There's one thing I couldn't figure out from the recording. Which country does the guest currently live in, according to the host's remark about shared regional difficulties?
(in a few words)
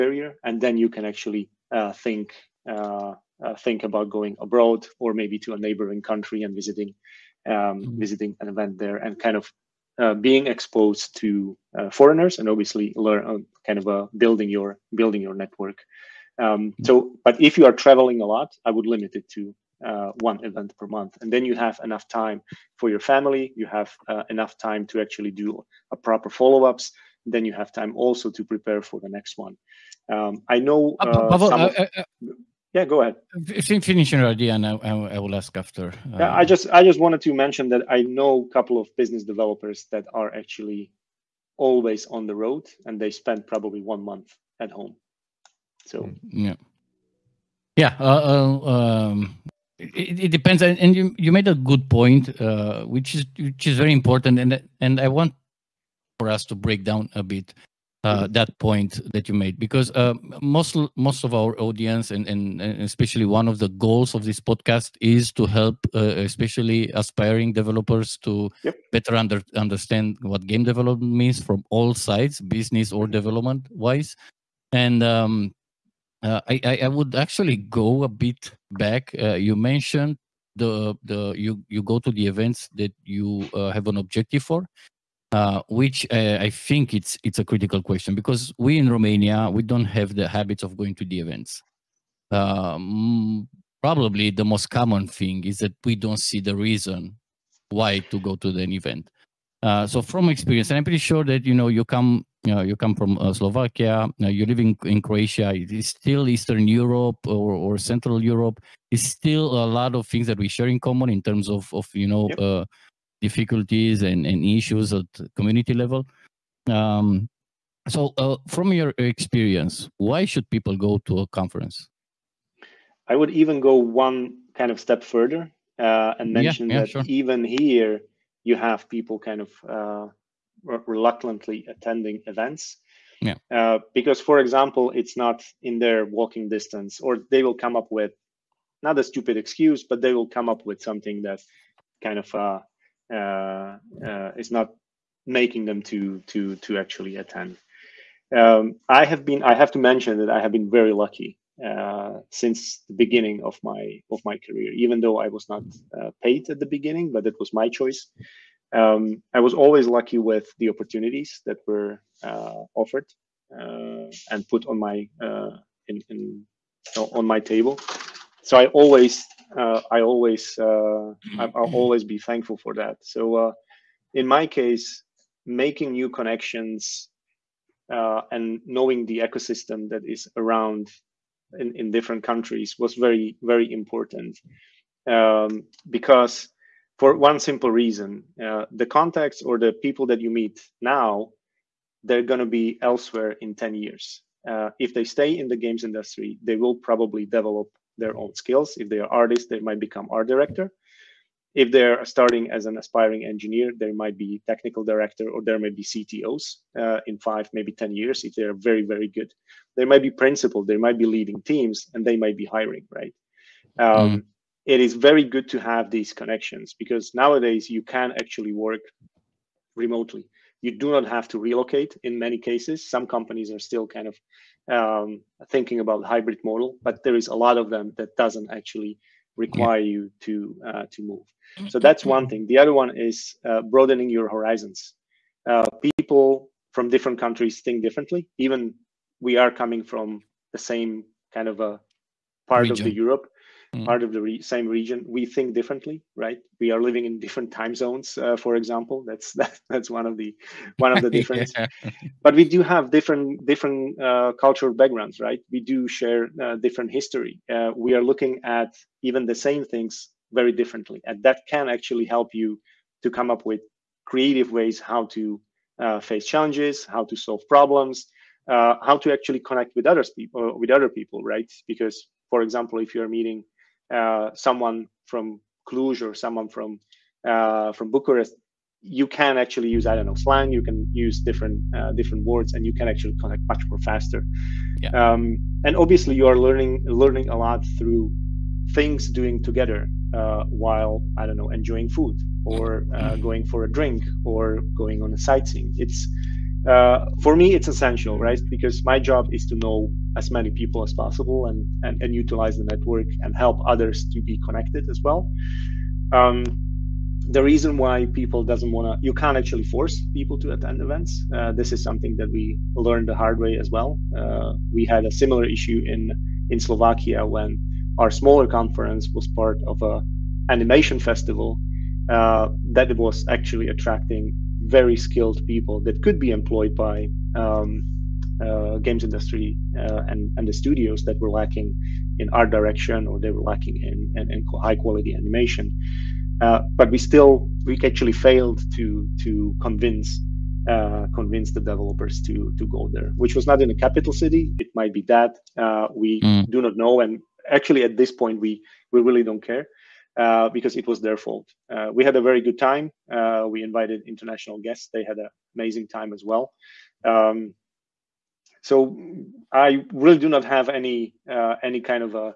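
Croatia.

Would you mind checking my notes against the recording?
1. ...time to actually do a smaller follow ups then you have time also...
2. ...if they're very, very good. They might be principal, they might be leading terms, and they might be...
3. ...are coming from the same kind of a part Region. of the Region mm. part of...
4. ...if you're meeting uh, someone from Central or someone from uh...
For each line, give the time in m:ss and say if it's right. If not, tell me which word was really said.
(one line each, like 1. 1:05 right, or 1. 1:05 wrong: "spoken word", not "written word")
1. 0:24 wrong: "proper", not "smaller"
2. 3:28 wrong: "teams", not "terms"
3. 3:59 wrong: "Europe", not "Region"
4. 4:32 wrong: "Cluj", not "Central".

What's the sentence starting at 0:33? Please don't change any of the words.
Finish your idea, and I, I will ask after.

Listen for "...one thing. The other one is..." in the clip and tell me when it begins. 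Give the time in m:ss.
3:52.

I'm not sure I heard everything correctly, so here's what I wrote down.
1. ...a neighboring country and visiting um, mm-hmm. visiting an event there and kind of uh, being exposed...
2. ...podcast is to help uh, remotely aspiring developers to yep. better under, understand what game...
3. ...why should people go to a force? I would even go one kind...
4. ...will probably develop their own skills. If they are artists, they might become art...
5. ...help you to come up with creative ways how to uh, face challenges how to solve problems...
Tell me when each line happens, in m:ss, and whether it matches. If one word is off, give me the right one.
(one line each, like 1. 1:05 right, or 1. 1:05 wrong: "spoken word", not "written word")
1. 0:05 right
2. 1:04 wrong: "especially", not "remotely"
3. 1:59 wrong: "conference", not "force"
4. 3:16 right
5. 4:22 right.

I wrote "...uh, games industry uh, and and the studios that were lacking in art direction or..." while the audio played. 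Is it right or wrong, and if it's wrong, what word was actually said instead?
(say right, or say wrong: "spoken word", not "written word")
right.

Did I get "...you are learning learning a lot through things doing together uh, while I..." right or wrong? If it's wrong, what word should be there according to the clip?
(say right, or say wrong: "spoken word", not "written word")
right.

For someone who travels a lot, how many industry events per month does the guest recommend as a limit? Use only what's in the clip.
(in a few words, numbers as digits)
1.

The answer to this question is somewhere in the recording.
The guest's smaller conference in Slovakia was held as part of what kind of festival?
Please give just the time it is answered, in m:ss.
5:20.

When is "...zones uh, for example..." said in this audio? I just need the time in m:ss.
4:07.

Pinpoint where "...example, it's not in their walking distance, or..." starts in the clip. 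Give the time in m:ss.
2:14.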